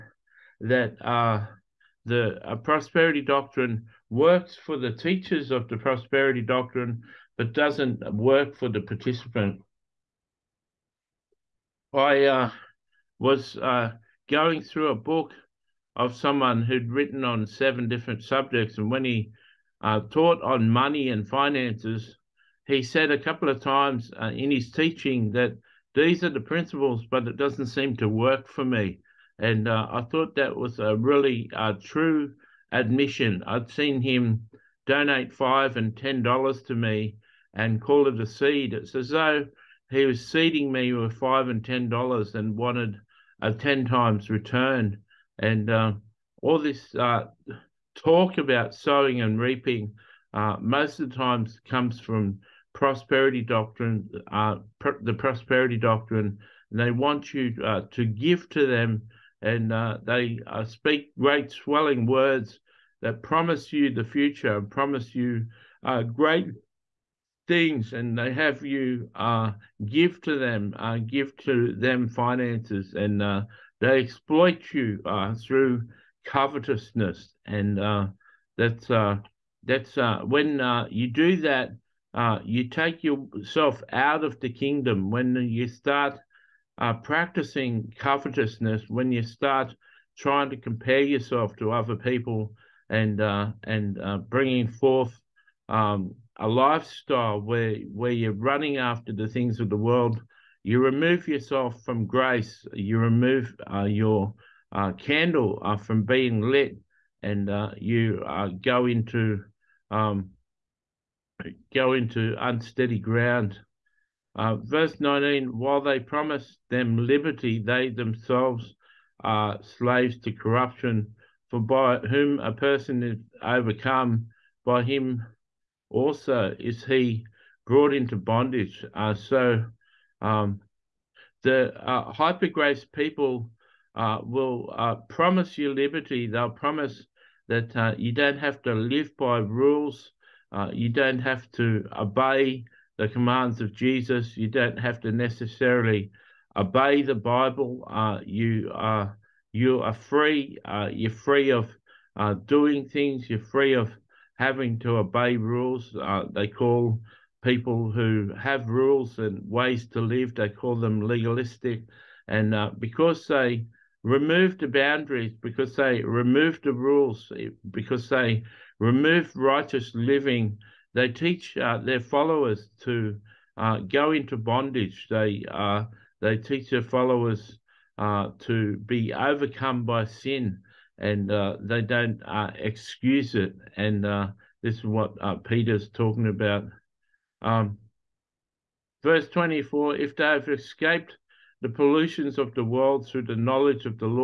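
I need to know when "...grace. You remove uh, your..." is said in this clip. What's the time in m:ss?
1:42.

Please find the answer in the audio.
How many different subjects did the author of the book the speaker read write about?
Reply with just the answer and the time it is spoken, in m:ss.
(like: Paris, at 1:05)
7, at 0:17.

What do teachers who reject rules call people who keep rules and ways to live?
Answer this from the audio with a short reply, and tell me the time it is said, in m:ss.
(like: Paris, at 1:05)
legalistic, at 2:41.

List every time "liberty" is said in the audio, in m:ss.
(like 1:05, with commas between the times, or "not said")
1:57, 2:15.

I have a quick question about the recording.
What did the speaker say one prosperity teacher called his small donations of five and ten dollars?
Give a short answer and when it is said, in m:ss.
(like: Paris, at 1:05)
a seed, at 0:38.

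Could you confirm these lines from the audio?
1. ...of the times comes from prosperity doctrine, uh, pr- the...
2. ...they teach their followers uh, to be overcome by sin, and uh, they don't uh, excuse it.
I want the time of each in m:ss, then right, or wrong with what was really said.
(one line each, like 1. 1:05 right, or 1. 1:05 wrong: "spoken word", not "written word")
1. 0:51 right
2. 2:56 right.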